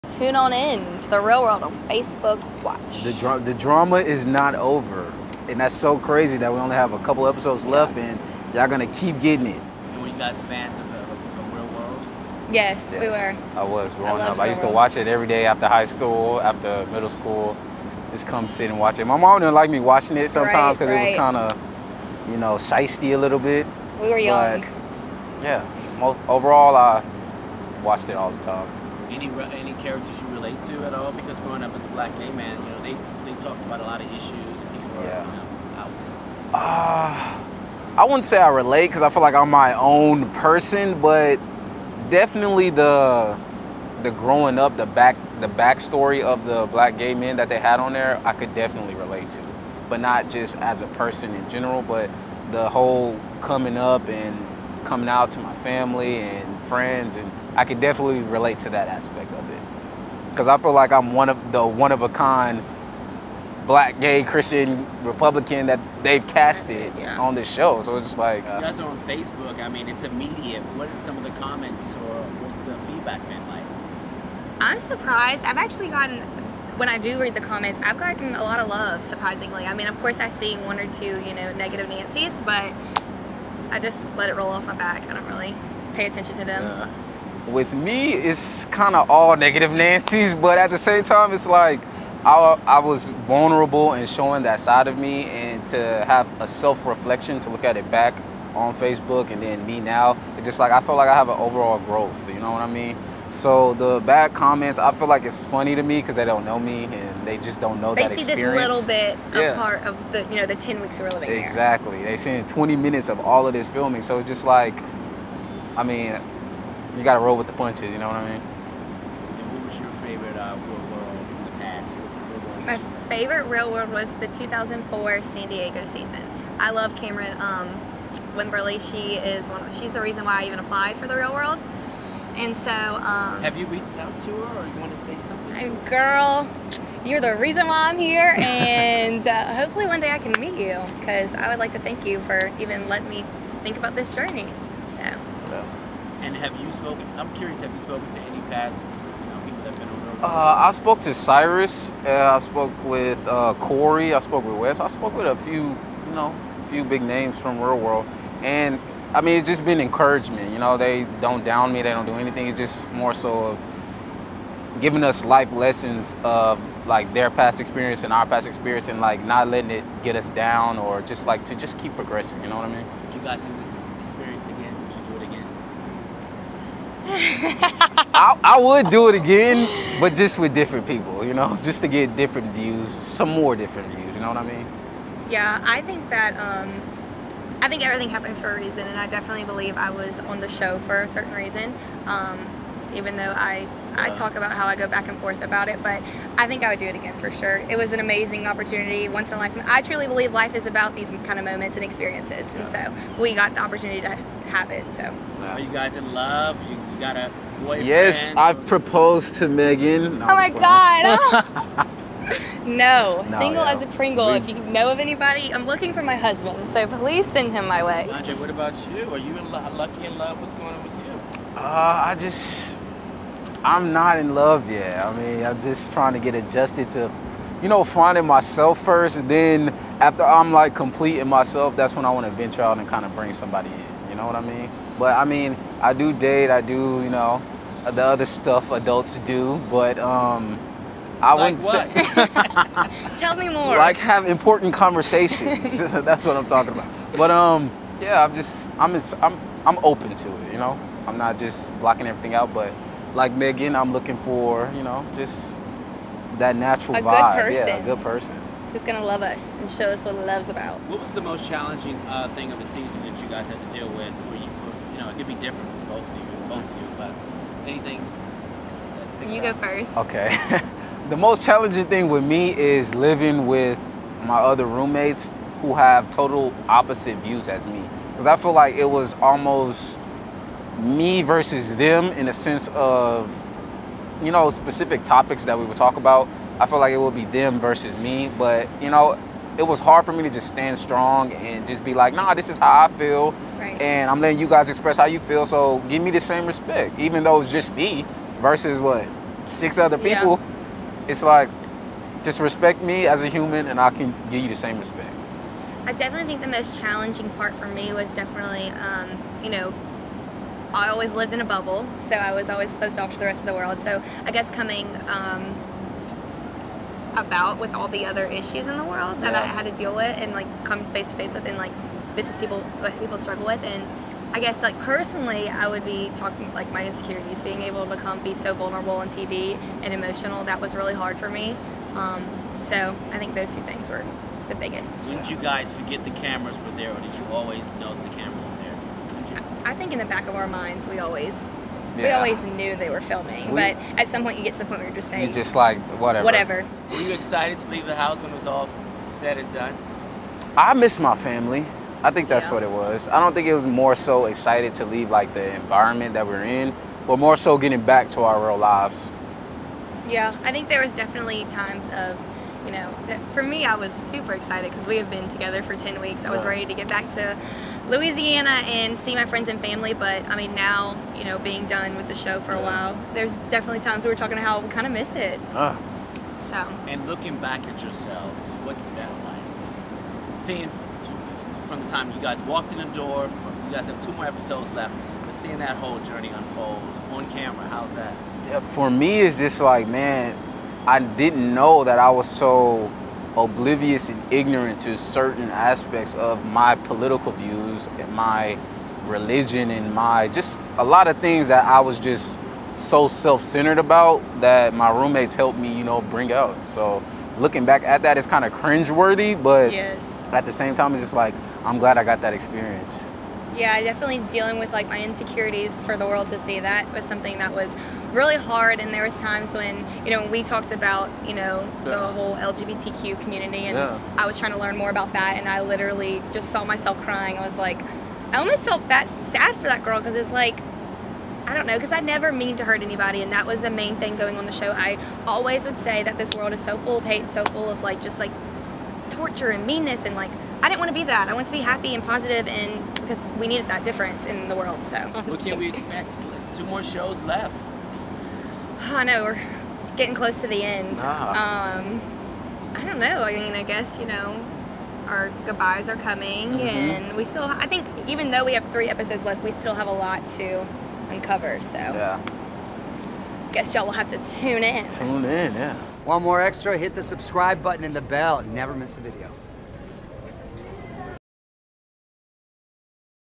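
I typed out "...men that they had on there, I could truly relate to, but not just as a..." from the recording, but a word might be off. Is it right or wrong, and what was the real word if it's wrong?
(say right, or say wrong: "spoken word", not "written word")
wrong: "definitely", not "truly".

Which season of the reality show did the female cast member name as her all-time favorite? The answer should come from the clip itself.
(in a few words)
2004 San Diego.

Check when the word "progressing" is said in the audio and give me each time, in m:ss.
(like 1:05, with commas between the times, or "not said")
2:51.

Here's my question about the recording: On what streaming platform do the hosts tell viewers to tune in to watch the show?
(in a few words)
Facebook Watch.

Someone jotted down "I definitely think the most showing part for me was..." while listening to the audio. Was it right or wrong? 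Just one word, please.
wrong.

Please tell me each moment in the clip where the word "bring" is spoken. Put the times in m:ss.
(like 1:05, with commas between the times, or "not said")
3:53, 6:46.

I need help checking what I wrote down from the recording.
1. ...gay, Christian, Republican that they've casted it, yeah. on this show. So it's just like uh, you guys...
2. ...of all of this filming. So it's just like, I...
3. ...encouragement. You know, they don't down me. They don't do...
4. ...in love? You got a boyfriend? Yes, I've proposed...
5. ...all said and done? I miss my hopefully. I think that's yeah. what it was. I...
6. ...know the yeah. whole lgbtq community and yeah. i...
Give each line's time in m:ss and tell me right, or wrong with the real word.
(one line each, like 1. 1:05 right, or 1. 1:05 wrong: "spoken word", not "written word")
1. 1:03 right
2. 1:53 right
3. 2:39 right
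4. 3:25 right
5. 5:48 wrong: "family", not "hopefully"
6. 7:01 right.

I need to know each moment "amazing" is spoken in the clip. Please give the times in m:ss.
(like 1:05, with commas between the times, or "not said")
3:17.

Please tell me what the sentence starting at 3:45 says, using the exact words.
I mean, I'm just trying to get adjusted to, you know, finding myself first.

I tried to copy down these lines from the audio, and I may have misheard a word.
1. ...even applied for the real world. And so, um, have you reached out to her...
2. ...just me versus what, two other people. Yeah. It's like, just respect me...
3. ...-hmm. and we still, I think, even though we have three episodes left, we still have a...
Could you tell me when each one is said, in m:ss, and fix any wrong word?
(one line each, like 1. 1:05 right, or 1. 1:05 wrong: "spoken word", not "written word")
1. 2:10 right
2. 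4:57 wrong: "six", not "two"
3. 7:36 right.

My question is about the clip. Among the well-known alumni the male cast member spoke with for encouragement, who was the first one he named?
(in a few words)
Cyrus.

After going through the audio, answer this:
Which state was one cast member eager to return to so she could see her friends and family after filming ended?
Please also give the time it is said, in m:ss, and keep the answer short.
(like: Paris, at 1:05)
Louisiana, at 6:07.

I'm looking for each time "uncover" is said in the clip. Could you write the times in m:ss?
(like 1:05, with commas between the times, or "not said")
7:41.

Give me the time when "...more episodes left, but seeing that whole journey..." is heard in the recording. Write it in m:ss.
6:24.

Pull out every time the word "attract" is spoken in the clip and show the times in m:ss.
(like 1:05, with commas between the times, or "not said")
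not said.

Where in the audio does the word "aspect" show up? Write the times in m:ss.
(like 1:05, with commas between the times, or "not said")
0:58, 6:35.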